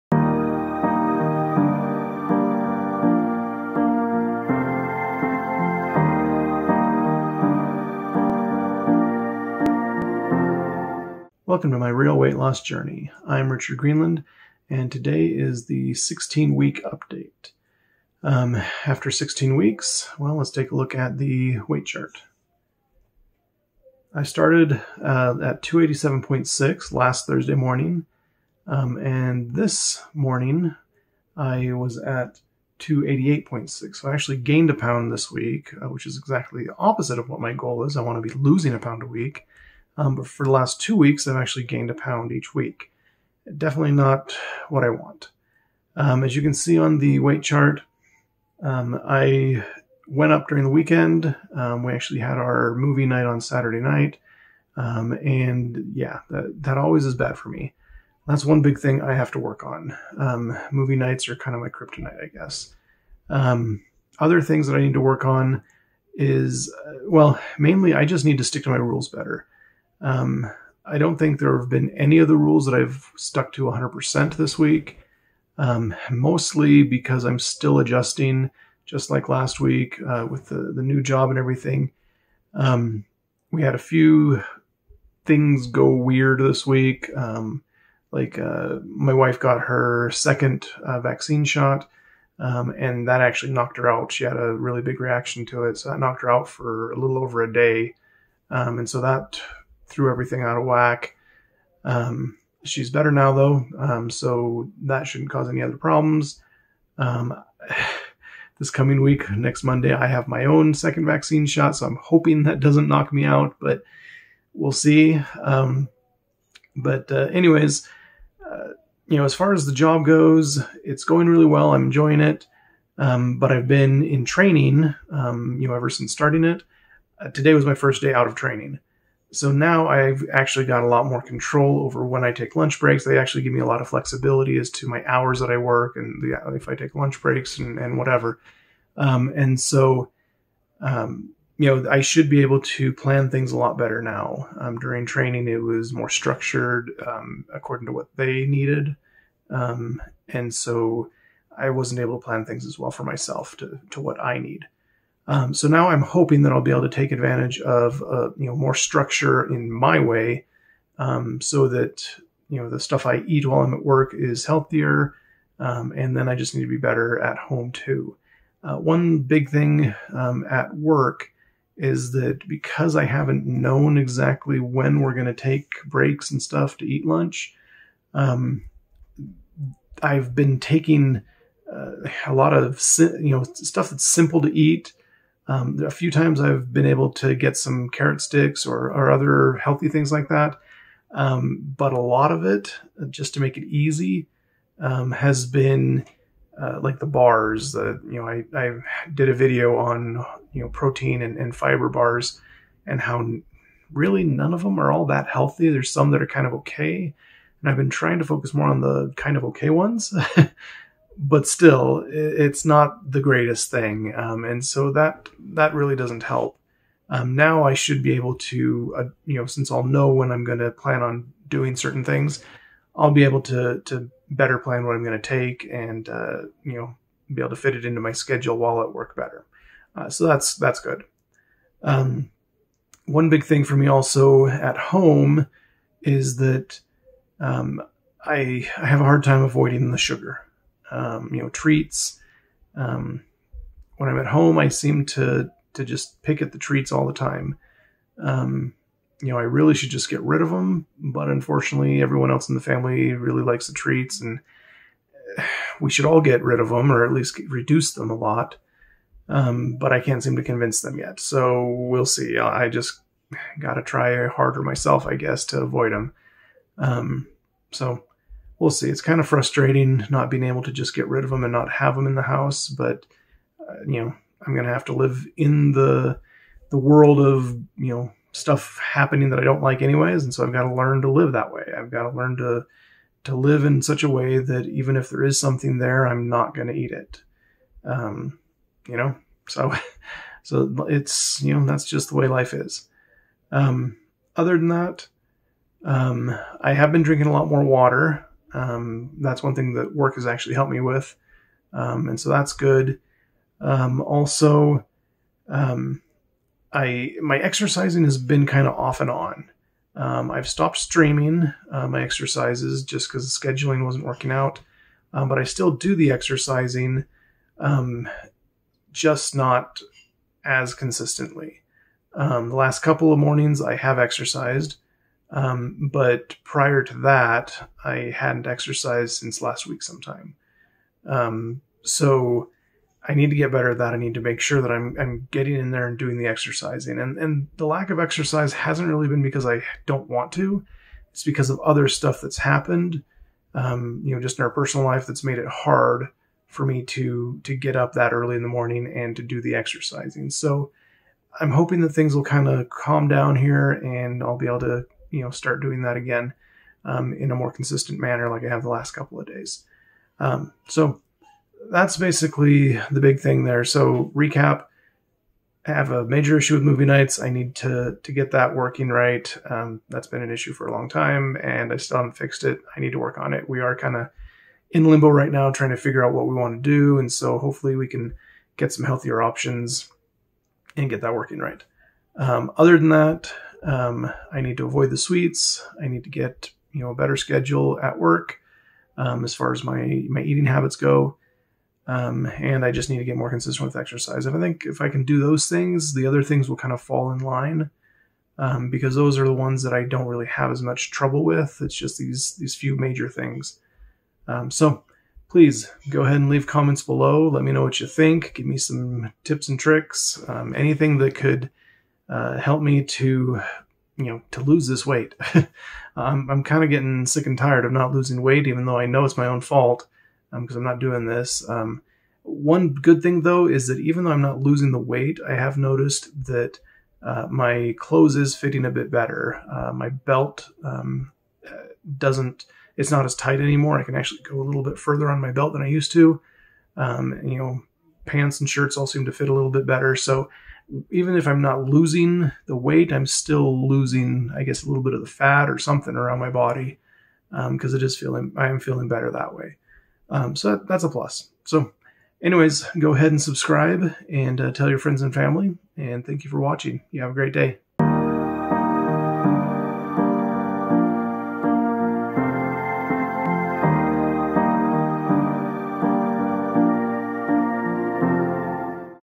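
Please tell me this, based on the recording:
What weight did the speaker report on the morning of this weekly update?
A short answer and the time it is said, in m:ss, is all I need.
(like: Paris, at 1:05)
288.6, at 0:32.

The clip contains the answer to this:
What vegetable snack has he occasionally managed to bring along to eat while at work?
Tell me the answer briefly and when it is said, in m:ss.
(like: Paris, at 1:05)
carrot sticks, at 3:07.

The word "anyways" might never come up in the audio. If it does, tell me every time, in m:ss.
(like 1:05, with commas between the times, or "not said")
1:57, 4:39, 7:32.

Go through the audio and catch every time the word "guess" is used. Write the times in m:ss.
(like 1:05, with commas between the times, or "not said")
1:02, 4:25, 7:24.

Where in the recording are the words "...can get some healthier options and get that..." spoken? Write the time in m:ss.
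6:17.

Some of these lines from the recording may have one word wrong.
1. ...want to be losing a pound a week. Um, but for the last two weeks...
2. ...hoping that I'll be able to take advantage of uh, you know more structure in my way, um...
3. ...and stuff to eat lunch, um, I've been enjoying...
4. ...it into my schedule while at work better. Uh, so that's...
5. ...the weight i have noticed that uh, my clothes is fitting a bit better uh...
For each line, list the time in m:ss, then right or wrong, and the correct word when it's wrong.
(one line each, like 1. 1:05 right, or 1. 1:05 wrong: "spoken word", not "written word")
1. 0:38 right
2. 2:36 right
3. 2:56 wrong: "taking", not "enjoying"
4. 3:47 right
5. 7:04 right.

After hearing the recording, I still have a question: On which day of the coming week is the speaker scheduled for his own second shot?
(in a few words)
Monday.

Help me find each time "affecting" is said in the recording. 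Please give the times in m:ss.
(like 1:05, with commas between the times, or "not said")
not said.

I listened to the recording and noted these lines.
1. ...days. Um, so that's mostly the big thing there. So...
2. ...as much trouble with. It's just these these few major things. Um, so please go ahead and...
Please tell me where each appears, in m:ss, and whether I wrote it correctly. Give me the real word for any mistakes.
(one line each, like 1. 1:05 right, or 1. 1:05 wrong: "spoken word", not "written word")
1. 5:59 wrong: "basically", not "mostly"
2. 6:40 right.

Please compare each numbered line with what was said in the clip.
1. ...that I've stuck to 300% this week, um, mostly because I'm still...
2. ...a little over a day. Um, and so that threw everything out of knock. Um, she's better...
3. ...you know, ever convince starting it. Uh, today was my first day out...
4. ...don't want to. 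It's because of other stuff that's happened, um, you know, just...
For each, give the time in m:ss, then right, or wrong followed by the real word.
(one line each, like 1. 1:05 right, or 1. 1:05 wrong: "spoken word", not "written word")
1. 1:12 wrong: "100", not "300"
2. 1:36 wrong: "whack", not "knock"
3. 2:05 wrong: "since", not "convince"
4. 5:39 right.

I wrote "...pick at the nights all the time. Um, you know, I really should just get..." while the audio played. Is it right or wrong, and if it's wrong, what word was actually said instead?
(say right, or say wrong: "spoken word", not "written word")
wrong: "treats", not "nights".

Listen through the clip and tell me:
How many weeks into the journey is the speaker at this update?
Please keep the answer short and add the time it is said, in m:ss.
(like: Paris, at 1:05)
16, at 0:15.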